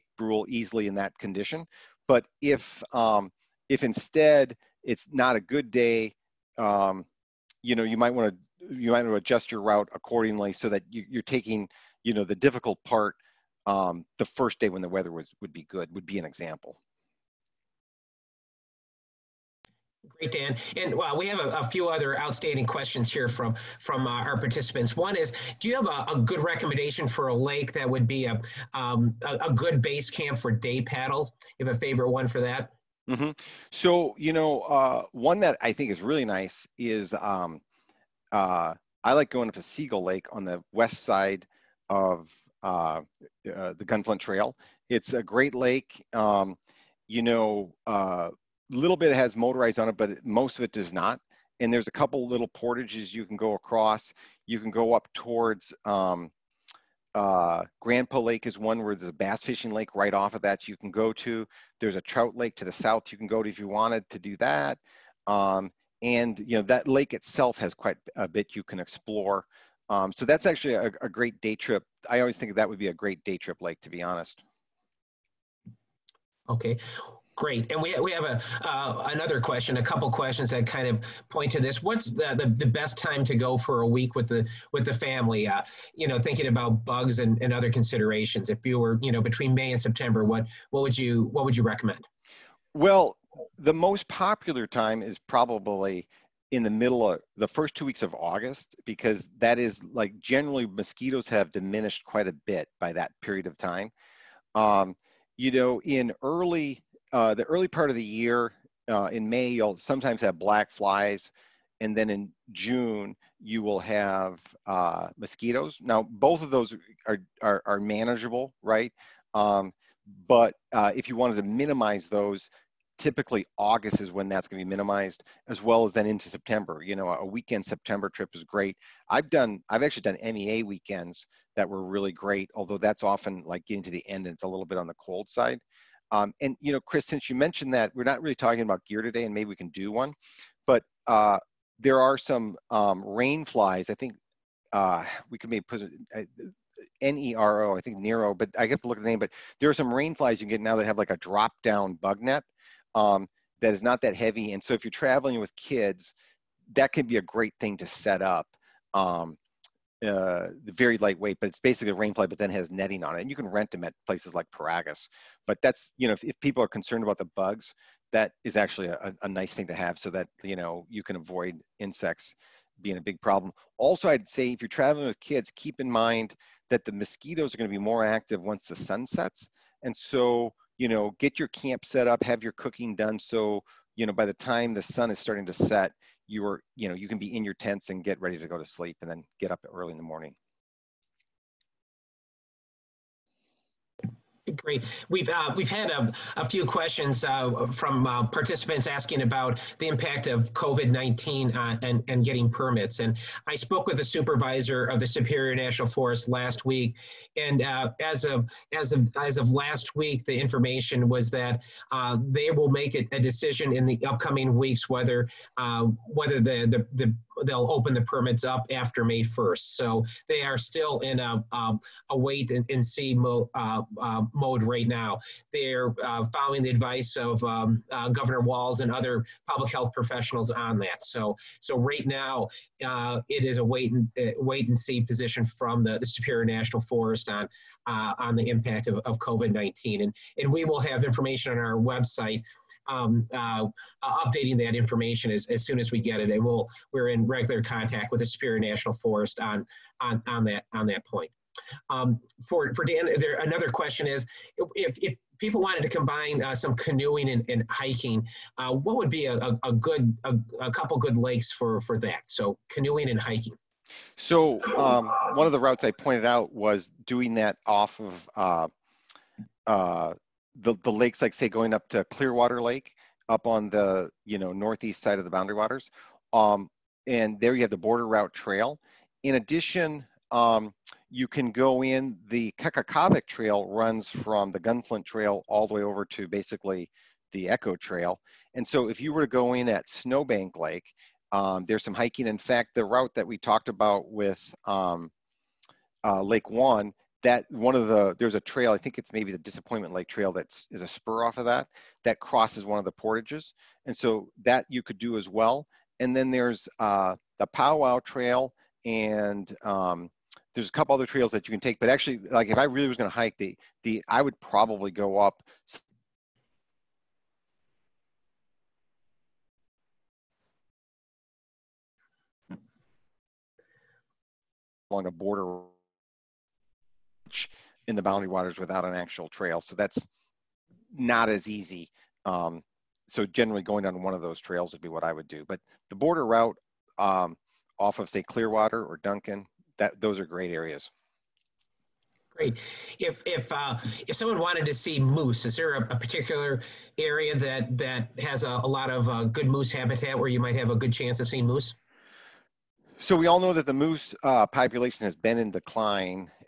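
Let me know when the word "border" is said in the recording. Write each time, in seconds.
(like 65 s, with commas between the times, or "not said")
277 s, 325 s, 335 s.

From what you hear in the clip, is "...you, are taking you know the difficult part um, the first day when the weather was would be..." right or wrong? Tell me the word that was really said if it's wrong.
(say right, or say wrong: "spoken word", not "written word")
right.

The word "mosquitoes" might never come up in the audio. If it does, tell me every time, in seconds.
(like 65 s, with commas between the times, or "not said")
100 s, 115 s, 176 s.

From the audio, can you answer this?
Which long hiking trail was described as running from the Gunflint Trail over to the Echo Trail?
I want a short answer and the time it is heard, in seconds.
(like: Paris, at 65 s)
Kekekabic Trail, at 282 s.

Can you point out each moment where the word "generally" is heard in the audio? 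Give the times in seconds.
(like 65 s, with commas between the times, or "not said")
100 s, 333 s.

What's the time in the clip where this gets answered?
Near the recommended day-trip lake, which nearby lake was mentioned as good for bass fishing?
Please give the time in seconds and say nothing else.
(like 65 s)
57 s.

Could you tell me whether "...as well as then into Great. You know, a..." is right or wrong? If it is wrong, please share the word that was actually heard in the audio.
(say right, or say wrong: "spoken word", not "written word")
wrong: "September", not "Great".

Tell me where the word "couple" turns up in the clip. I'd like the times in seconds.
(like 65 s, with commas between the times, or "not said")
51 s, 79 s, 260 s, 310 s.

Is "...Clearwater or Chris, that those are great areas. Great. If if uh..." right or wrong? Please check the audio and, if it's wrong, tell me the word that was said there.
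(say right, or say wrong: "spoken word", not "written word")
wrong: "Duncan", not "Chris".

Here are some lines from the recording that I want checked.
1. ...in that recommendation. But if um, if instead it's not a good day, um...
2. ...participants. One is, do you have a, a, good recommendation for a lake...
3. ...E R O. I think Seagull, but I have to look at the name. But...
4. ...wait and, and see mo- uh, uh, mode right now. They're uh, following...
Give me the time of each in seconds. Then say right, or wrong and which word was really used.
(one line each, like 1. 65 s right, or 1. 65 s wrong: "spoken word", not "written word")
1. 0 s wrong: "condition", not "recommendation"
2. 24 s right
3. 147 s wrong: "Nero", not "Seagull"
4. 222 s right.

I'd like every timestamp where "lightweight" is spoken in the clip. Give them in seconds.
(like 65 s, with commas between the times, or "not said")
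160 s.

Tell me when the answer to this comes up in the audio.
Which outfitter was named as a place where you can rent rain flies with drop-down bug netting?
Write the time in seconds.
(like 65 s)
164 s.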